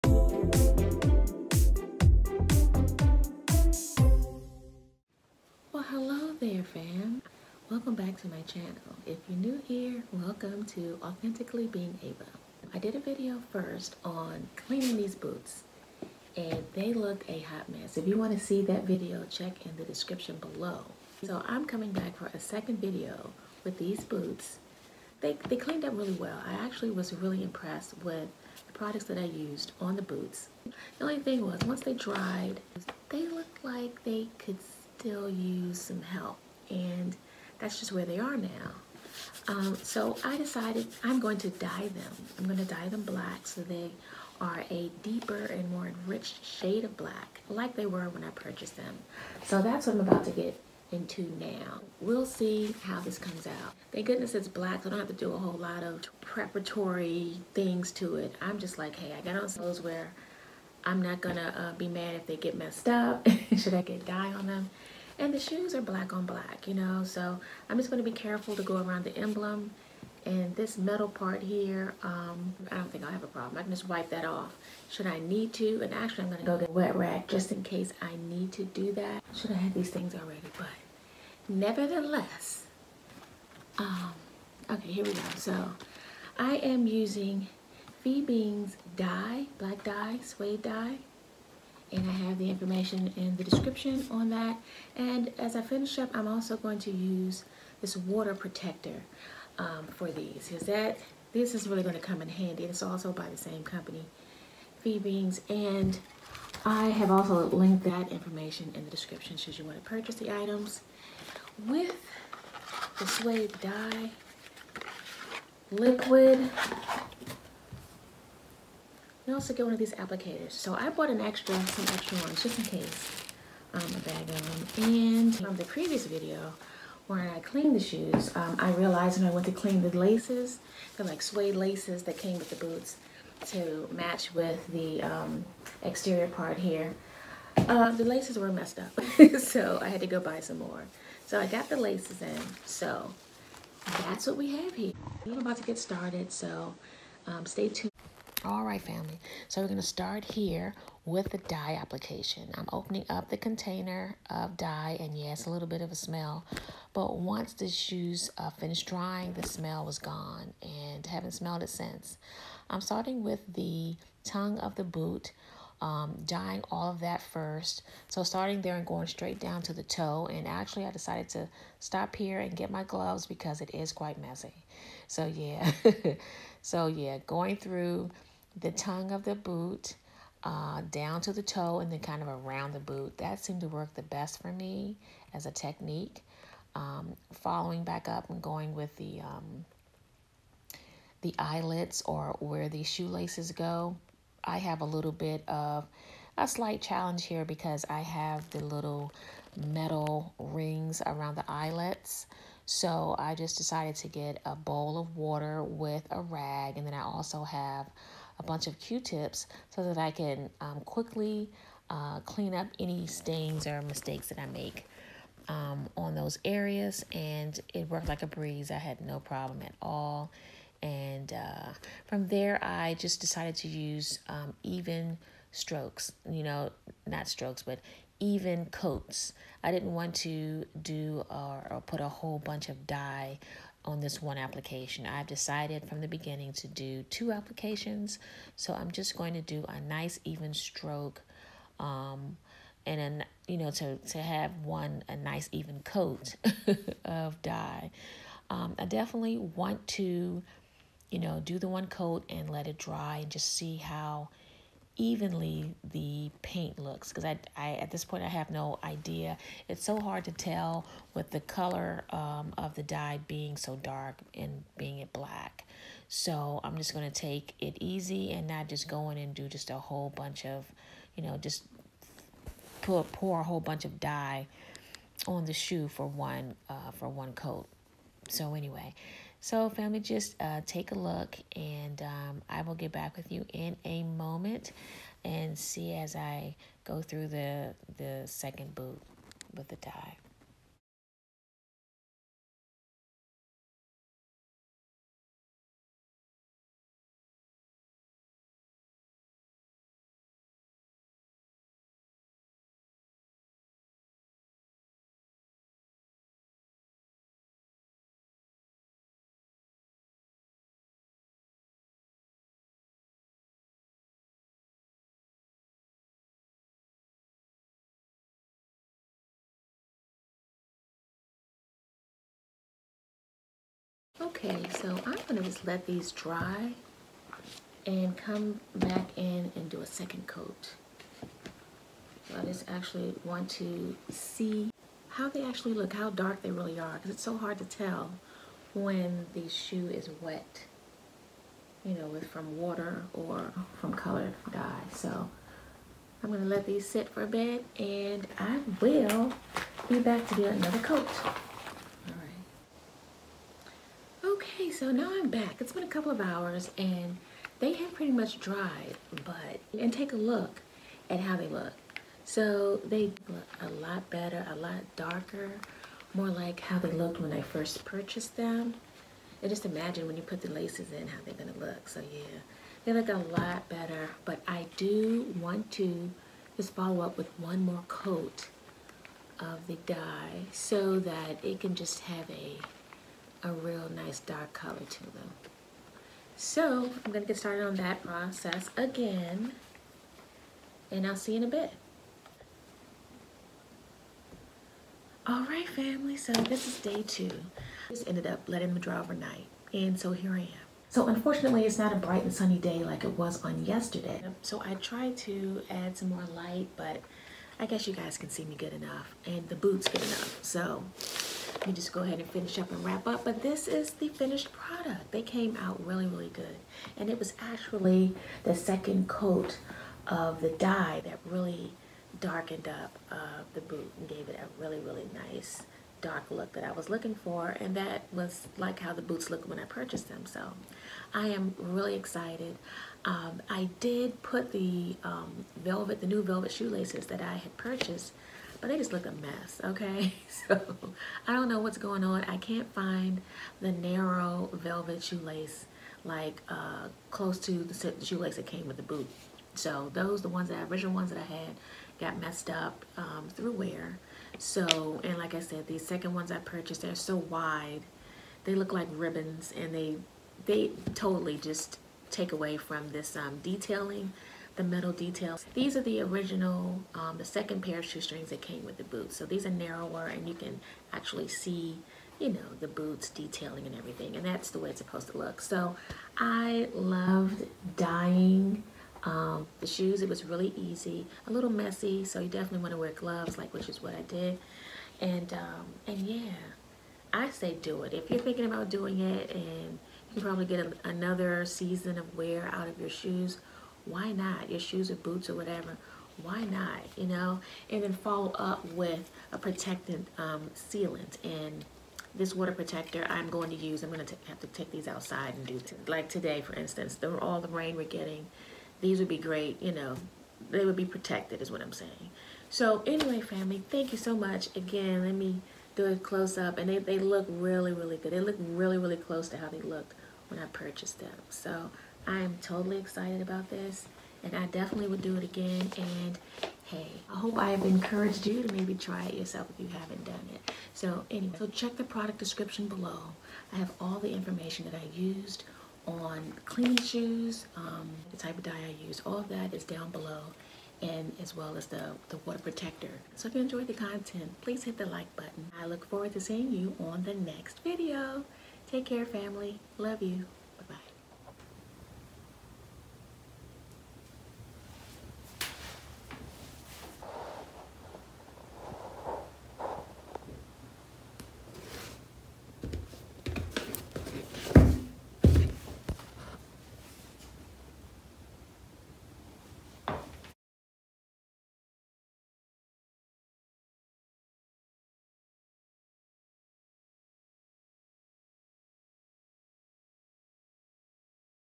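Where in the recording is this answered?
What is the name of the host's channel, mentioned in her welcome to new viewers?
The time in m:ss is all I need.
0:11.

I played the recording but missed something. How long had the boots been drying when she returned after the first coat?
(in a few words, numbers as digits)
A couple of hours.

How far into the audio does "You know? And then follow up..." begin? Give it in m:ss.
8:16.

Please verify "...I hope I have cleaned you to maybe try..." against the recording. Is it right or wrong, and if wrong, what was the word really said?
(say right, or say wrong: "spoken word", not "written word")
wrong: "encouraged", not "cleaned".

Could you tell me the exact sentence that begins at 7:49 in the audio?
So these are narrower and you can actually see, you know, the boots detailing and everything.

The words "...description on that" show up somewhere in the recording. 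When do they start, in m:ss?
1:33.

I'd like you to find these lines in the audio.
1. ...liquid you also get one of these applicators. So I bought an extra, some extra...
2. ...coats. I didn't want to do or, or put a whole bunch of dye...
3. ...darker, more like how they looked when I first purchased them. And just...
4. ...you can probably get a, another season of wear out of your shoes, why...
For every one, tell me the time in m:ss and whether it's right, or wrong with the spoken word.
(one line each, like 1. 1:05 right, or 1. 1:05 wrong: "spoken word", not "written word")
1. 1:55 right
2. 3:48 right
3. 6:04 right
4. 8:10 right.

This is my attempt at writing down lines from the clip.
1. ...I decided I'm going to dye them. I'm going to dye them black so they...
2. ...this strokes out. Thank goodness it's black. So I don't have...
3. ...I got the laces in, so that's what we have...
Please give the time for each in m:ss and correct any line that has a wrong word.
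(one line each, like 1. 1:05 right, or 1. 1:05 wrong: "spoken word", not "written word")
1. 0:40 right
2. 0:53 wrong: "comes", not "strokes"
3. 2:21 right.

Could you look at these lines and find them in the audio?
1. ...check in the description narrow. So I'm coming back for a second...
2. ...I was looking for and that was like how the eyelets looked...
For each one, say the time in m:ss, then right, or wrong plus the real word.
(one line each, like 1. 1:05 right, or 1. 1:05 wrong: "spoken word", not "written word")
1. 0:19 wrong: "below", not "narrow"
2. 7:06 wrong: "boots", not "eyelets".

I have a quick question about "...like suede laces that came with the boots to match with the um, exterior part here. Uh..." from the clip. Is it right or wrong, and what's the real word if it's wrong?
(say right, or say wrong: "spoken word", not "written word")
right.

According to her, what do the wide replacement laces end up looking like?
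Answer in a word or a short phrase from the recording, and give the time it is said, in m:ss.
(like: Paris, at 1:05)
Ribbons, at 7:38.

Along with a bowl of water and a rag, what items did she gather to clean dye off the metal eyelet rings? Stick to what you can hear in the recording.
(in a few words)
Q-tips.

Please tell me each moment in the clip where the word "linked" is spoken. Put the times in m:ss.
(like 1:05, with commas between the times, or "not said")
1:47.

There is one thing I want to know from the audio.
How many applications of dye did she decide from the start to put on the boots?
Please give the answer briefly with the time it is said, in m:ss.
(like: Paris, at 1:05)
2, at 3:57.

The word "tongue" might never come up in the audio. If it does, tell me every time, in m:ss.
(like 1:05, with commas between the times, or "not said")
2:44, 2:58.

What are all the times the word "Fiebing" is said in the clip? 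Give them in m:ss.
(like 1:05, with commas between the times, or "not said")
1:28, 1:44.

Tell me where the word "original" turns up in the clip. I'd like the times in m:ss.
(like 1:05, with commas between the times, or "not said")
7:30, 7:46.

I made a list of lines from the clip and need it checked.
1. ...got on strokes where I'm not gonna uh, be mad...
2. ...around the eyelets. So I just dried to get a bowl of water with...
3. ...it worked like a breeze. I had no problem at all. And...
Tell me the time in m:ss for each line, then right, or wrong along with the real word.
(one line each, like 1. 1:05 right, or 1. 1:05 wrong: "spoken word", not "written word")
1. 0:59 wrong: "clothes", not "strokes"
2. 3:21 wrong: "decided", not "dried"
3. 3:37 right.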